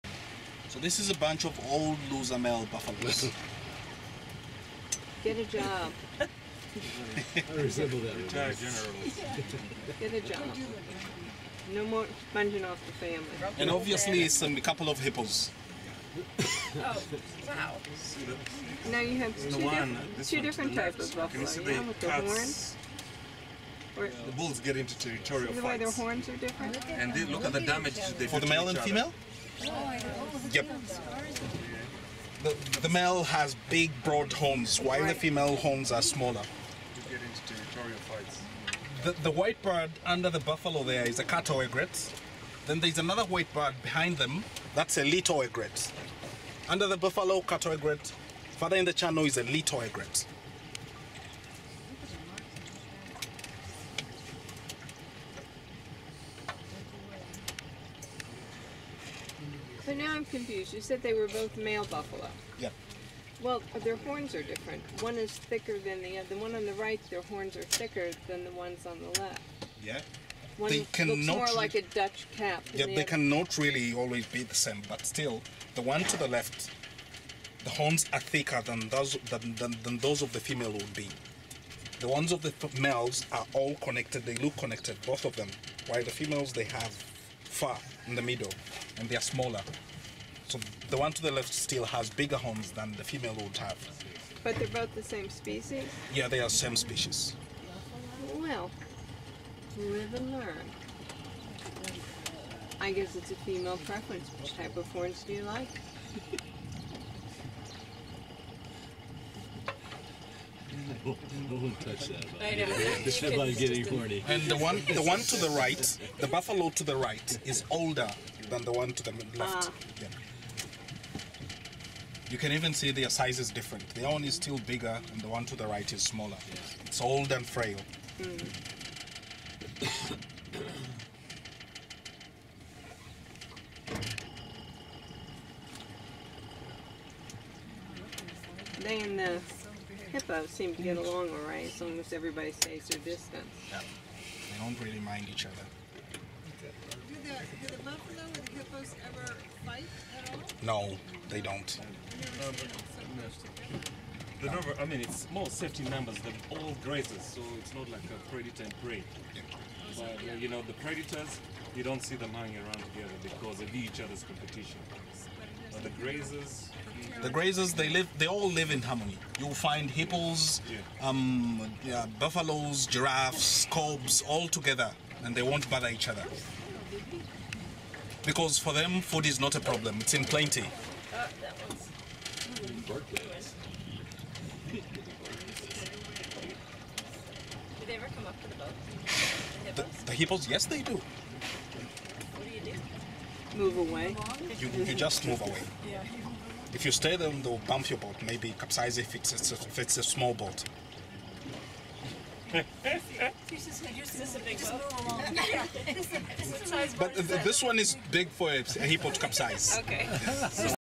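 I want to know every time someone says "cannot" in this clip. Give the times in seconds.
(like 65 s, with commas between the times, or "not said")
73 s.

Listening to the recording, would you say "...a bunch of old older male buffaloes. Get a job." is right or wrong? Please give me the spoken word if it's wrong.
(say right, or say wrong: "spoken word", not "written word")
wrong: "loser", not "older".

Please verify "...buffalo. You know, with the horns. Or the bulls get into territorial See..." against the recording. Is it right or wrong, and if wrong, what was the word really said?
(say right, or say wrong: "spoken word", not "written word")
right.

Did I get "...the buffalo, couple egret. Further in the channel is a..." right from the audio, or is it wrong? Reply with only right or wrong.
wrong.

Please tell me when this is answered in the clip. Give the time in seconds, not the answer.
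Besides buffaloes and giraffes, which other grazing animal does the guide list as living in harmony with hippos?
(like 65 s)
173 s.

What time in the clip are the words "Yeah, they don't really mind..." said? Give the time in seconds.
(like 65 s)
143 s.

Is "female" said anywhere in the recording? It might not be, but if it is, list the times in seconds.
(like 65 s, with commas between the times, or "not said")
28 s, 35 s, 80 s, 86 s, 93 s, 103 s.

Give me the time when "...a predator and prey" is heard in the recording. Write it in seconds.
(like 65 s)
158 s.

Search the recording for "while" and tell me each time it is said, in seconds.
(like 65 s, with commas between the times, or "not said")
34 s, 85 s.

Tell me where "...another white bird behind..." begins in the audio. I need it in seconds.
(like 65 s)
42 s.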